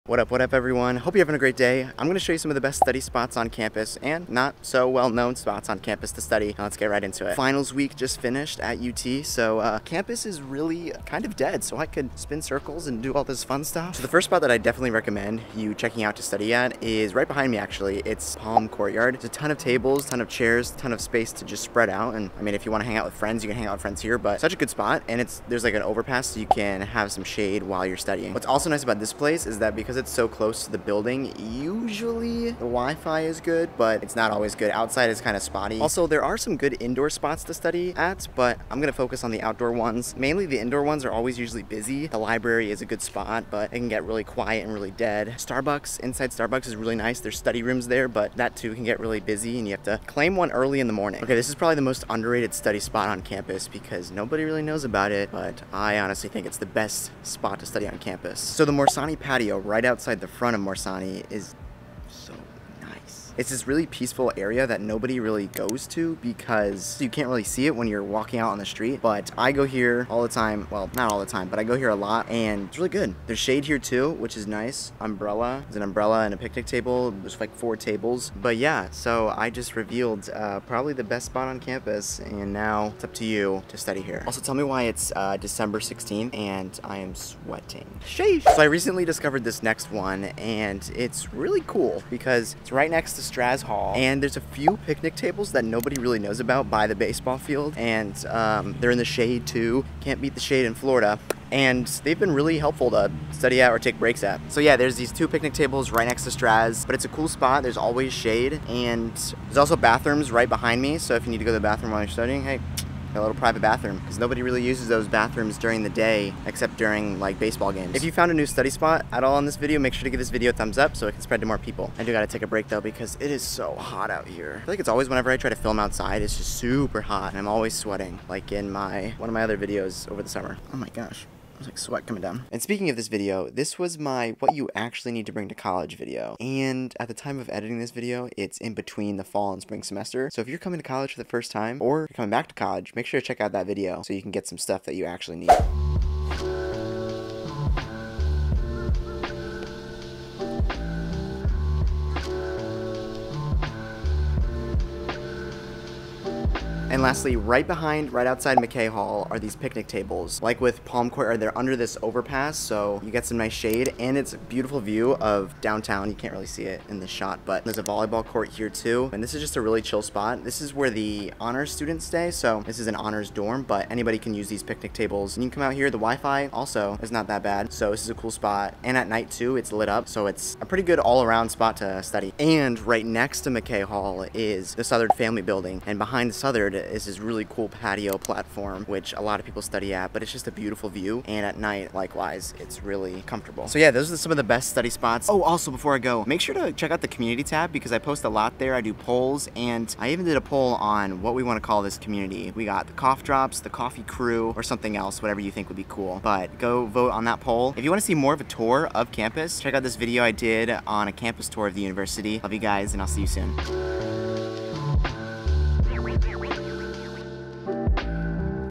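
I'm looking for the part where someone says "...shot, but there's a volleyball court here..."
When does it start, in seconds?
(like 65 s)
167 s.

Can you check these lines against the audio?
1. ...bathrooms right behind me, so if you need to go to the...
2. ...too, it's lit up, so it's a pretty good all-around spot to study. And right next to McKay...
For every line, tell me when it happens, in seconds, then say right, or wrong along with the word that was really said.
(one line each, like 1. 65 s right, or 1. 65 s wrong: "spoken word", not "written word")
1. 109 s right
2. 179 s right.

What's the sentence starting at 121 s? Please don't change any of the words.
I do gotta take a break though because it is so hot out here.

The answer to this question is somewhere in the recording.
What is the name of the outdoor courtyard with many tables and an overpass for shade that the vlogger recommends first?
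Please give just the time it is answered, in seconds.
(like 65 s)
18 s.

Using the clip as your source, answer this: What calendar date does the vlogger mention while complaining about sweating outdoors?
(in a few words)
December 16th.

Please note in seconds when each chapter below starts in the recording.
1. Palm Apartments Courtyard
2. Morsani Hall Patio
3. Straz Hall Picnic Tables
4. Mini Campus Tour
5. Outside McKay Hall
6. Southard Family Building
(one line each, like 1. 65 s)
1. 13 s
2. 51 s
3. 88 s
4. 145 s
5. 156 s
6. 182 s.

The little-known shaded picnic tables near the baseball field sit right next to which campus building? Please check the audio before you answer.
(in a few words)
Straz Hall.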